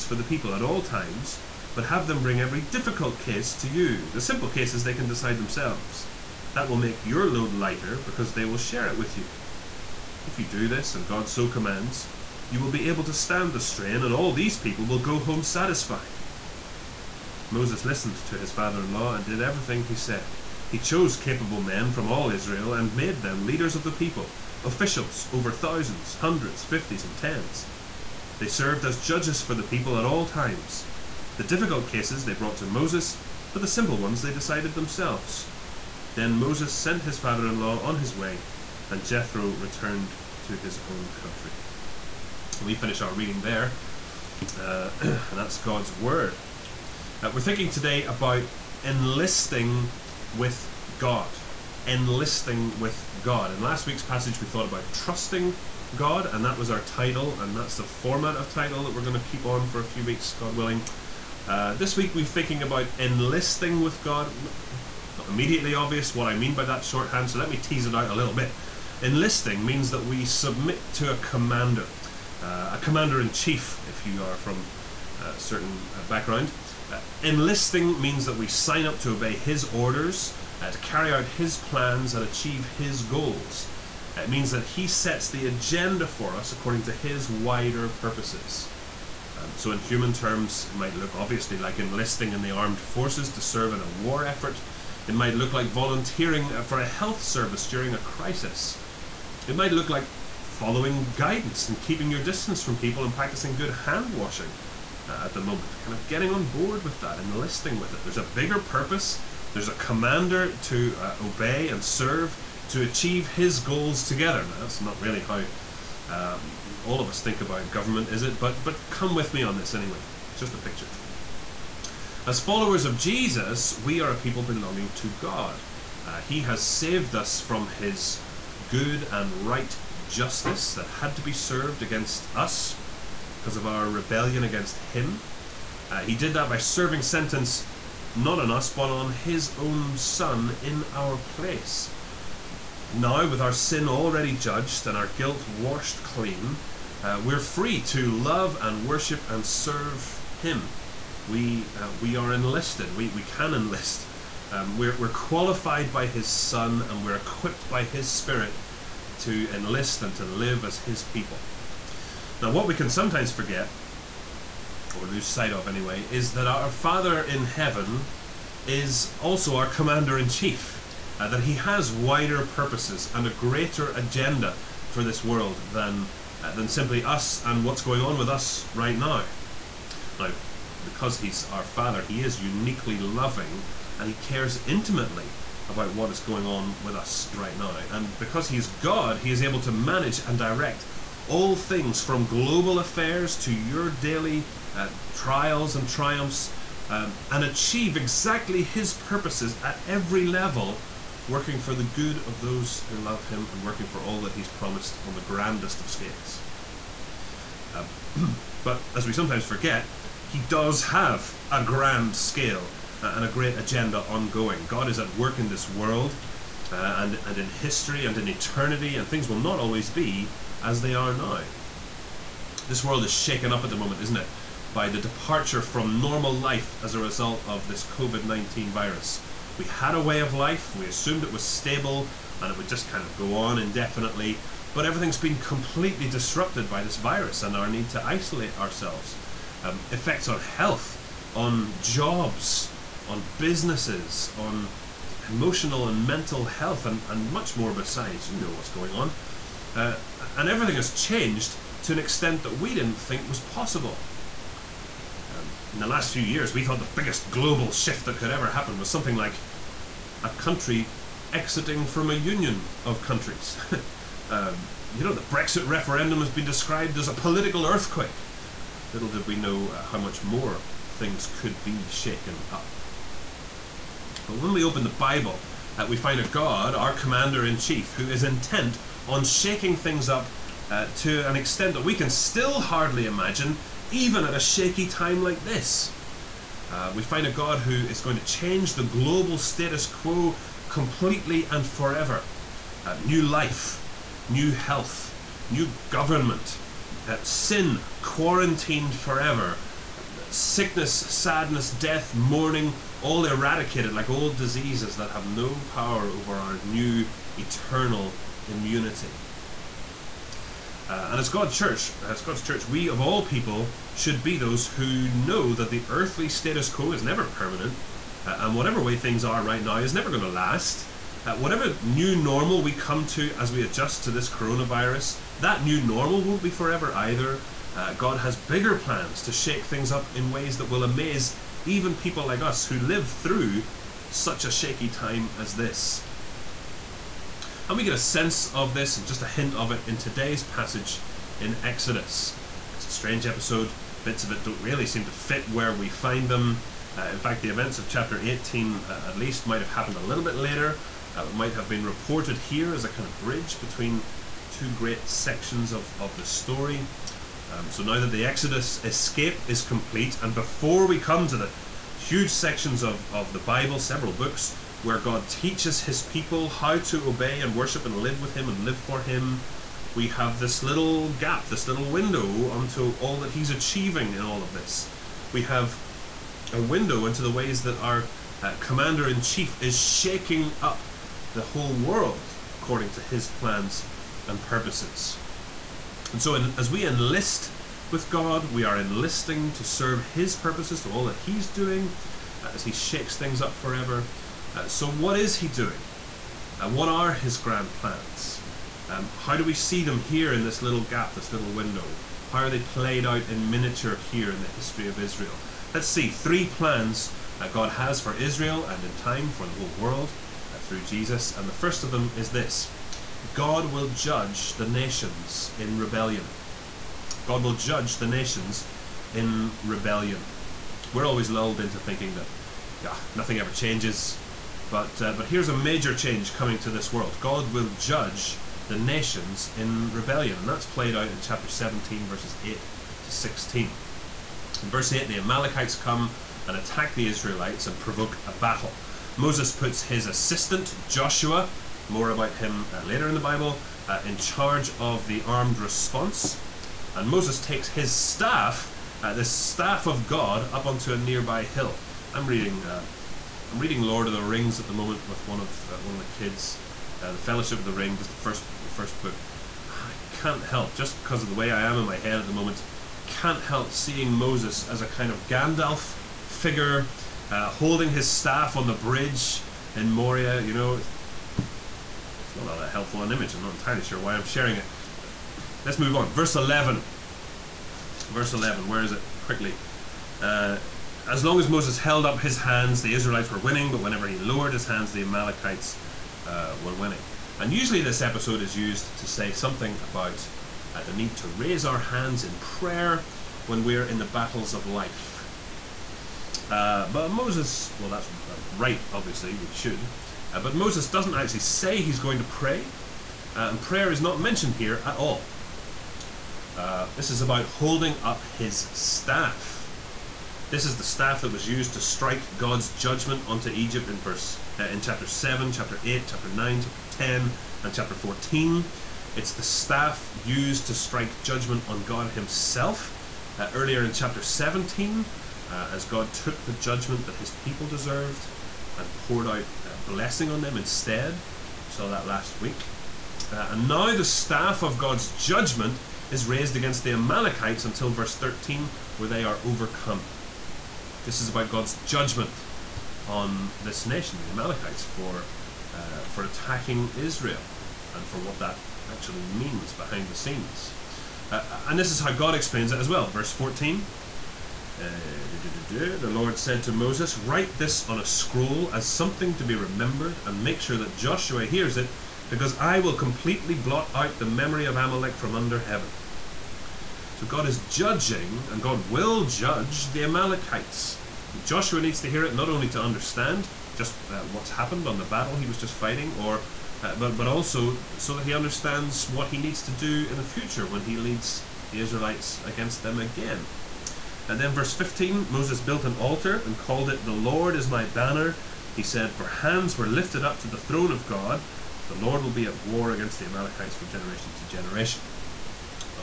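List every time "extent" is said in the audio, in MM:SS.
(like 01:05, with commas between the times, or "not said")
04:11, 04:41.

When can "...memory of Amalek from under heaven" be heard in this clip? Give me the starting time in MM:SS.
09:24.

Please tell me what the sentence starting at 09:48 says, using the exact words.
He said, For hands were lifted up to the throne of God.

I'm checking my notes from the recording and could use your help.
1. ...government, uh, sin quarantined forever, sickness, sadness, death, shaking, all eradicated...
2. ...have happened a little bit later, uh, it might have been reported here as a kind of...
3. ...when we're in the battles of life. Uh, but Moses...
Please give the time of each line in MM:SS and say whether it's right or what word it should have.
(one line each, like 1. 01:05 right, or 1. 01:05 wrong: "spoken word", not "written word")
1. 04:55 wrong: "mourning", not "shaking"
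2. 05:49 right
3. 08:13 right.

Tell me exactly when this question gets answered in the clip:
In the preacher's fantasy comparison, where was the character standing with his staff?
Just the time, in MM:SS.
07:48.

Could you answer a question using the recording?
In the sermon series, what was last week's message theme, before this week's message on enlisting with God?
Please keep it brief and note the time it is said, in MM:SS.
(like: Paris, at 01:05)
Trusting God, at 00:54.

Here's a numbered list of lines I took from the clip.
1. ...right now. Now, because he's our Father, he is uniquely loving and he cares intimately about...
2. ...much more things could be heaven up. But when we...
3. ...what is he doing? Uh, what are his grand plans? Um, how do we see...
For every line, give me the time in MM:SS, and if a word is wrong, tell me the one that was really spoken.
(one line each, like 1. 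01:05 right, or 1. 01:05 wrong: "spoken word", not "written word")
1. 02:58 right
2. 04:29 wrong: "shaken", not "heaven"
3. 06:34 right.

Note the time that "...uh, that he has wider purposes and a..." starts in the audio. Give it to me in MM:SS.
02:51.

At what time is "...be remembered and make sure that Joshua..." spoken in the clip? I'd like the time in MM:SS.
09:19.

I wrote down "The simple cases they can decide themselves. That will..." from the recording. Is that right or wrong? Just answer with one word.
right.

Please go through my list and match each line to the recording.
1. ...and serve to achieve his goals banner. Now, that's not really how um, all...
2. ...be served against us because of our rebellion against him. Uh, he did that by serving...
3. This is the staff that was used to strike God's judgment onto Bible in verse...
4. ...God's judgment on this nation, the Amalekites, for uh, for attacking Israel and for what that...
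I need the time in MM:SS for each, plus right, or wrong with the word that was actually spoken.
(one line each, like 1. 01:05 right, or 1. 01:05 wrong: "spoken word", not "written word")
1. 01:51 wrong: "together", not "banner"
2. 02:11 right
3. 08:30 wrong: "Egypt", not "Bible"
4. 09:01 right.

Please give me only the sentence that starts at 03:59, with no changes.
Um, effects on health, on jobs, on businesses, on emotional and mental health, and, and much more besides.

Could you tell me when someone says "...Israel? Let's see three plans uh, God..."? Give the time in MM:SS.
06:44.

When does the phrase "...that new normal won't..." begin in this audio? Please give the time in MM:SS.
05:25.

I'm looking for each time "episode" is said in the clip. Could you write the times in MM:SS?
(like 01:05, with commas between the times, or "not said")
05:43, 08:08.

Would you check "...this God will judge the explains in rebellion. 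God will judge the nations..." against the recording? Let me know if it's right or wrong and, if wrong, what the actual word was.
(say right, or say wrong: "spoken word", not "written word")
wrong: "nations", not "explains".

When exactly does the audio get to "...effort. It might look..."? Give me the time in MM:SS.
01:34.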